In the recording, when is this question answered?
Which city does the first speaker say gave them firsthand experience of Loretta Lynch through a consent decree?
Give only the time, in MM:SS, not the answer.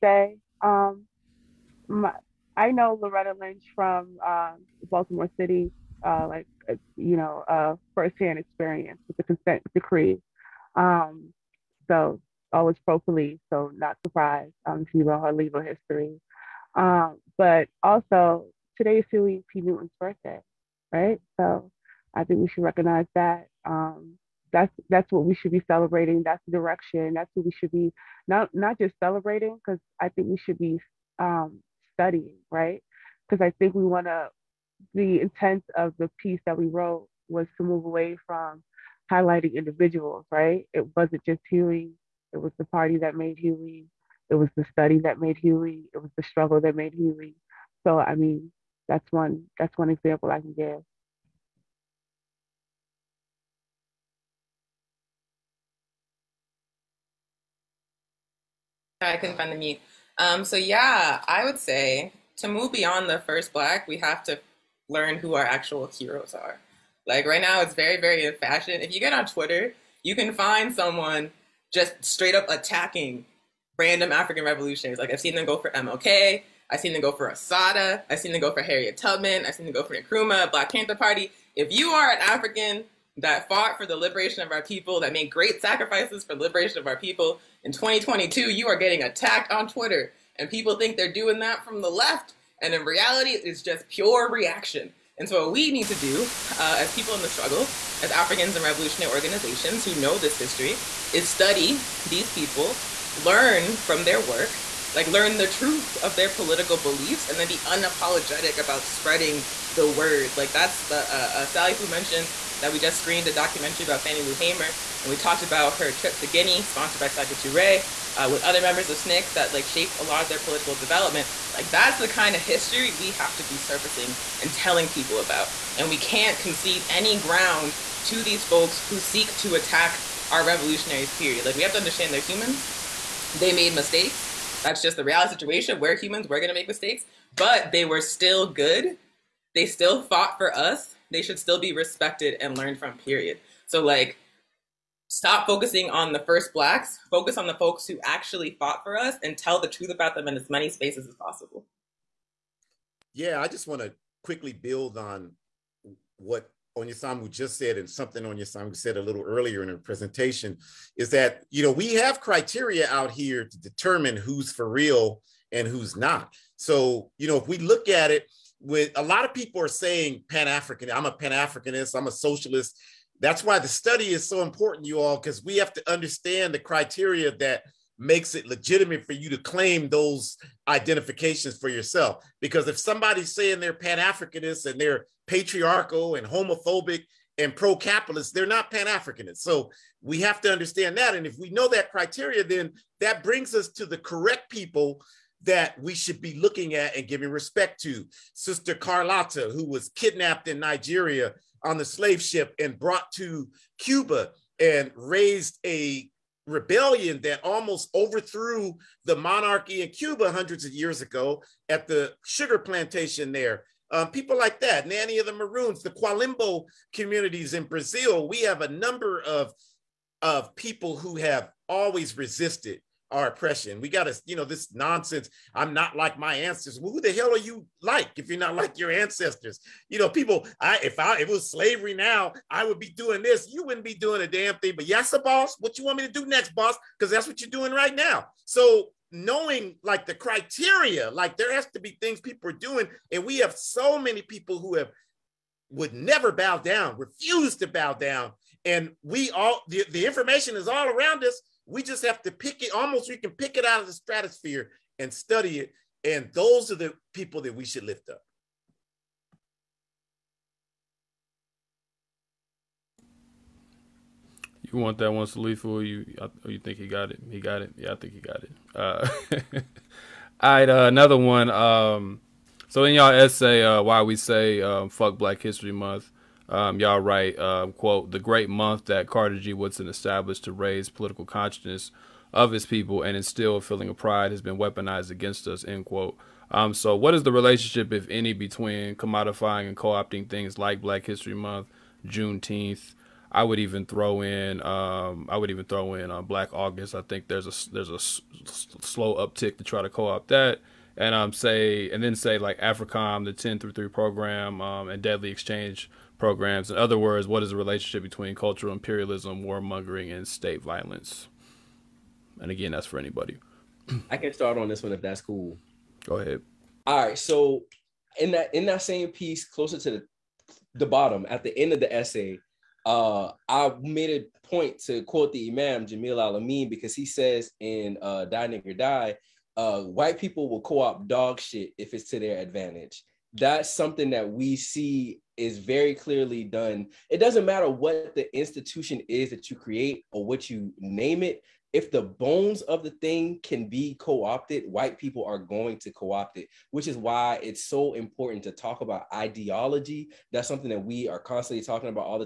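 00:04.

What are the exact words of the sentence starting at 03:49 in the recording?
You know, people, I if I if it was slavery now, I would be doing this.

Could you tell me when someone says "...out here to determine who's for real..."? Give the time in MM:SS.
02:42.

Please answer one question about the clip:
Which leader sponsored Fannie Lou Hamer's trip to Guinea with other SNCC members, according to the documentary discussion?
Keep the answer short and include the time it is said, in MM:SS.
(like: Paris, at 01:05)
Sekou Touré, at 01:57.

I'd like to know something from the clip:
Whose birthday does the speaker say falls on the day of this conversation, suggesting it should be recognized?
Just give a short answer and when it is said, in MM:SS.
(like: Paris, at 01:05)
Huey P. Newton, at 00:19.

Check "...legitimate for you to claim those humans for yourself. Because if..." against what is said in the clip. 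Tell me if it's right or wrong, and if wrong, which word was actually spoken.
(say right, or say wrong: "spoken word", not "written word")
wrong: "identifications", not "humans".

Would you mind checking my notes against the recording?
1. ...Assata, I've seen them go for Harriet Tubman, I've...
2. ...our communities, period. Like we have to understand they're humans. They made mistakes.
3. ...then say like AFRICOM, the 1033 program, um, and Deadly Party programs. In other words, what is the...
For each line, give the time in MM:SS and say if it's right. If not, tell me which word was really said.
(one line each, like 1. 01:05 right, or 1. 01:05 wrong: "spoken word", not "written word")
1. 01:17 right
2. 02:10 wrong: "revolutionaries", not "communities"
3. 05:02 wrong: "Exchange", not "Party".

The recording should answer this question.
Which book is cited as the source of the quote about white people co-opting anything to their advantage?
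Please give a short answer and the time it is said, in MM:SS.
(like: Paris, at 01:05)
Die Nigger Die, at 05:28.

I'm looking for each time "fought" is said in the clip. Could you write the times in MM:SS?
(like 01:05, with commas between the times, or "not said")
01:23, 02:20, 02:28.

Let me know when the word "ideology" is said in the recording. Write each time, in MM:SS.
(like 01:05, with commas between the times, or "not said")
05:49.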